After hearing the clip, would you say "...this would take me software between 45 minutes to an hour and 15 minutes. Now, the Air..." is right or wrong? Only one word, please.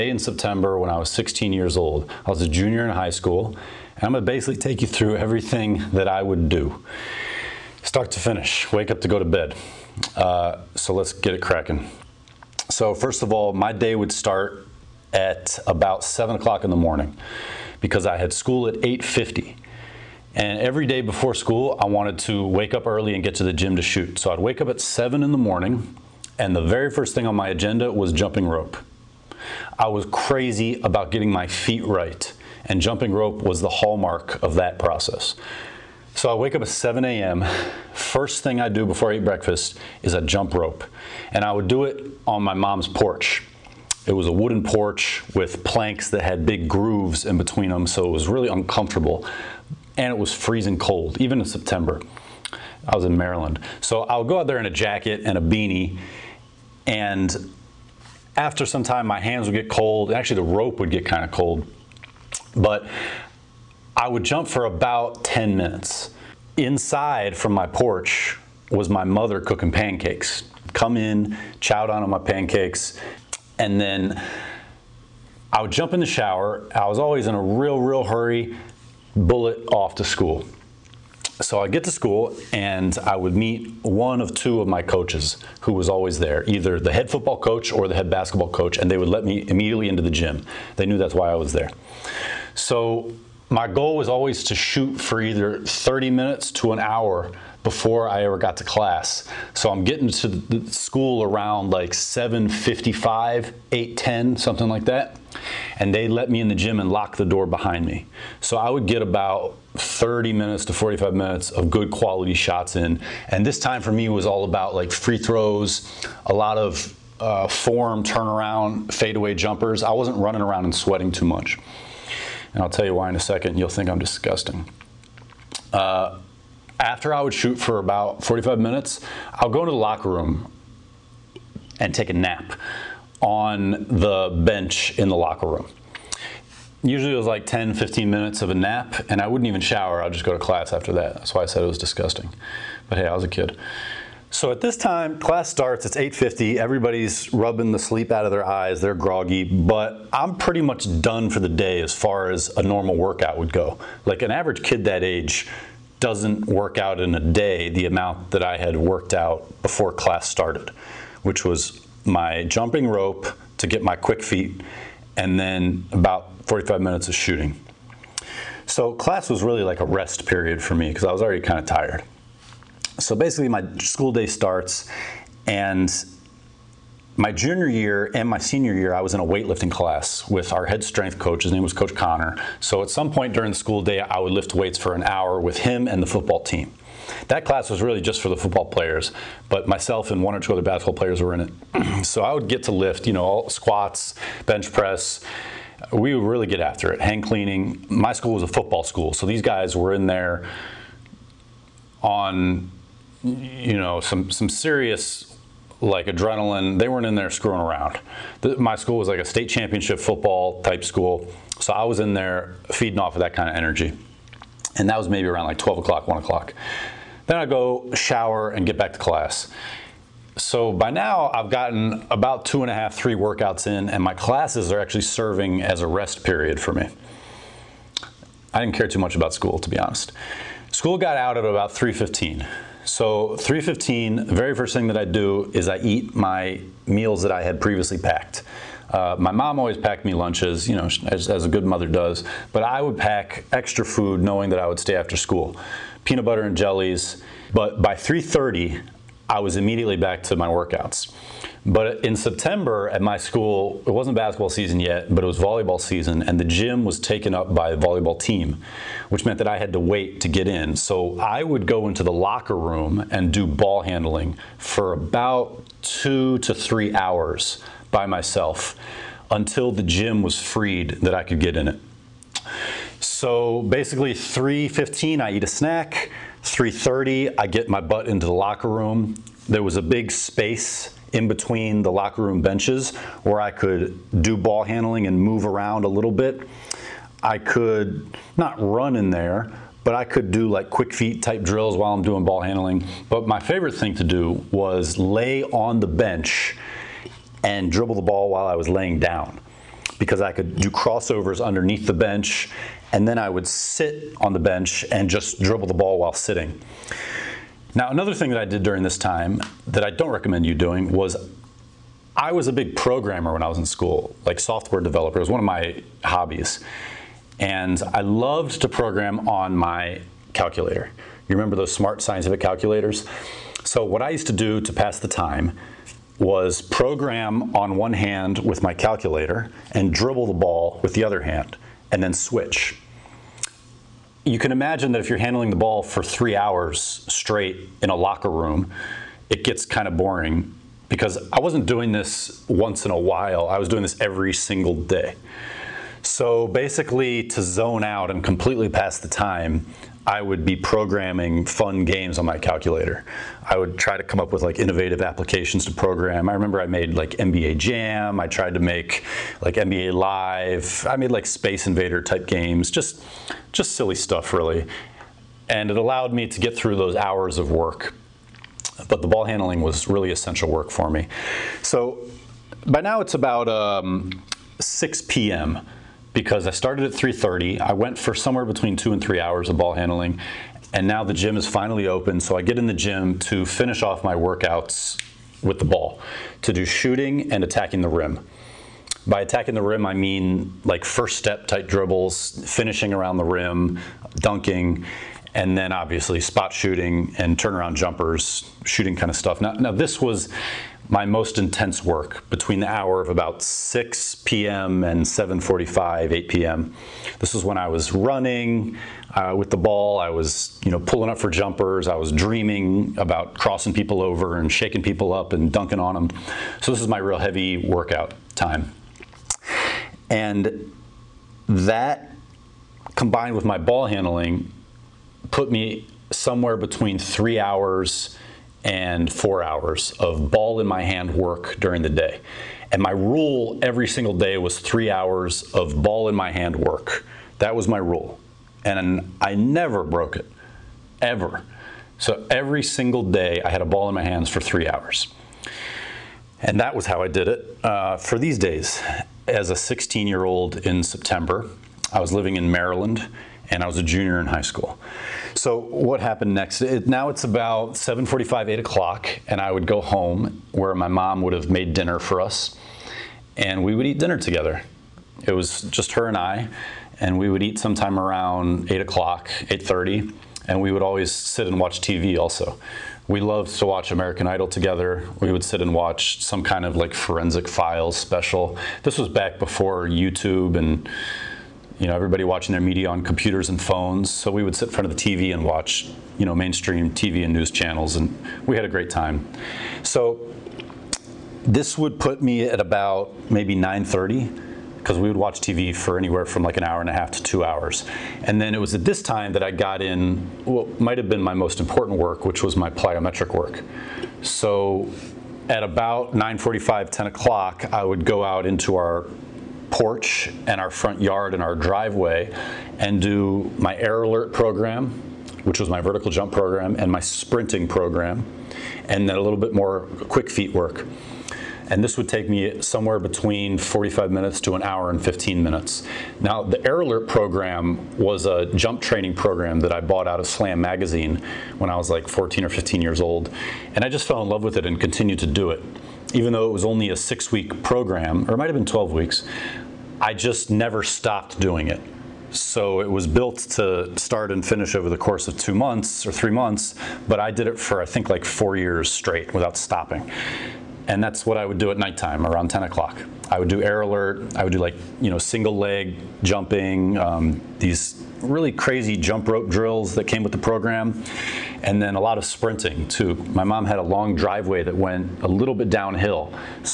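wrong.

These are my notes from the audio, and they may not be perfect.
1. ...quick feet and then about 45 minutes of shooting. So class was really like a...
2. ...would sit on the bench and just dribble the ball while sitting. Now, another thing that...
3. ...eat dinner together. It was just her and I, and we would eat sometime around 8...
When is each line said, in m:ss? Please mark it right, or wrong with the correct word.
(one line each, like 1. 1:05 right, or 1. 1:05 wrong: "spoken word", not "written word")
1. 2:43 right
2. 5:03 right
3. 7:43 right.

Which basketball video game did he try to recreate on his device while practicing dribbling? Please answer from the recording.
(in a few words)
NBA Jam.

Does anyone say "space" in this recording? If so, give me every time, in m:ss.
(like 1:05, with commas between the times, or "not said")
4:40, 6:01.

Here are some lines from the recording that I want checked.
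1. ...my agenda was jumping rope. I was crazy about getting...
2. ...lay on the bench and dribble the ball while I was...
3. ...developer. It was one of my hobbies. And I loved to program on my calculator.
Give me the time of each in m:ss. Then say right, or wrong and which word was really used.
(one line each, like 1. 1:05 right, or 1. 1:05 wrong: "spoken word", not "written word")
1. 0:27 right
2. 4:54 right
3. 5:14 right.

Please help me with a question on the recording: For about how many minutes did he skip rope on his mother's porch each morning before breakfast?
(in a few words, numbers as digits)
10 minutes.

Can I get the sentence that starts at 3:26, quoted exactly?
They weren't in there screwing around.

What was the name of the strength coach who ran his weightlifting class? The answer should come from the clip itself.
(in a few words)
Coach Connor.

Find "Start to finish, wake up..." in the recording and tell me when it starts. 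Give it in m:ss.
0:07.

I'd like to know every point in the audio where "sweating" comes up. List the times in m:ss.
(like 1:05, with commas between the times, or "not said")
2:00.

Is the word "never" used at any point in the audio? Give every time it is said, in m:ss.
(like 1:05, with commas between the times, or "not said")
7:19, 9:00.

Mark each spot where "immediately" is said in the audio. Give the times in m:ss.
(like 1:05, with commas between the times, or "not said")
1:29, 4:09.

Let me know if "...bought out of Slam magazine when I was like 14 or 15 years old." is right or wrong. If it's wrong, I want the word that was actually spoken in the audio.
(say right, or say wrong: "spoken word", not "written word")
right.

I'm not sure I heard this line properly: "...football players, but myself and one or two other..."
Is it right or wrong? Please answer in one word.
right.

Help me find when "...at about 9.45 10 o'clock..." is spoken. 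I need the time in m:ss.
8:25.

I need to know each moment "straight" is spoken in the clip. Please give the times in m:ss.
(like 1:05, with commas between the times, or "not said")
5:37, 9:08.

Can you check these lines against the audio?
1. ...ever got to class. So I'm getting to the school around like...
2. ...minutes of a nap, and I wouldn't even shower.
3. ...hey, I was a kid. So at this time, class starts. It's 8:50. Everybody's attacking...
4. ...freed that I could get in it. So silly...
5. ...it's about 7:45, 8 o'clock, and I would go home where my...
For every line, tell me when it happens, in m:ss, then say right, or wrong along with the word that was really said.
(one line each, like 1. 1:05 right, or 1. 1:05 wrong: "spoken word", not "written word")
1. 1:38 right
2. 2:18 right
3. 2:22 wrong: "rubbing", not "attacking"
4. 4:30 wrong: "basically", not "silly"
5. 7:37 right.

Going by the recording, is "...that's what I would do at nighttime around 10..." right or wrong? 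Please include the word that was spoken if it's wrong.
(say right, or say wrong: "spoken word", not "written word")
right.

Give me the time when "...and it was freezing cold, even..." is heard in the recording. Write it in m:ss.
0:49.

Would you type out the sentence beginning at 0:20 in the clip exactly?
And every day before school, I wanted to wake up early and get to the gym to shoot.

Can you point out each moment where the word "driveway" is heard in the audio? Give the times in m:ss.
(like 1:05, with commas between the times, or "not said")
8:31, 9:24.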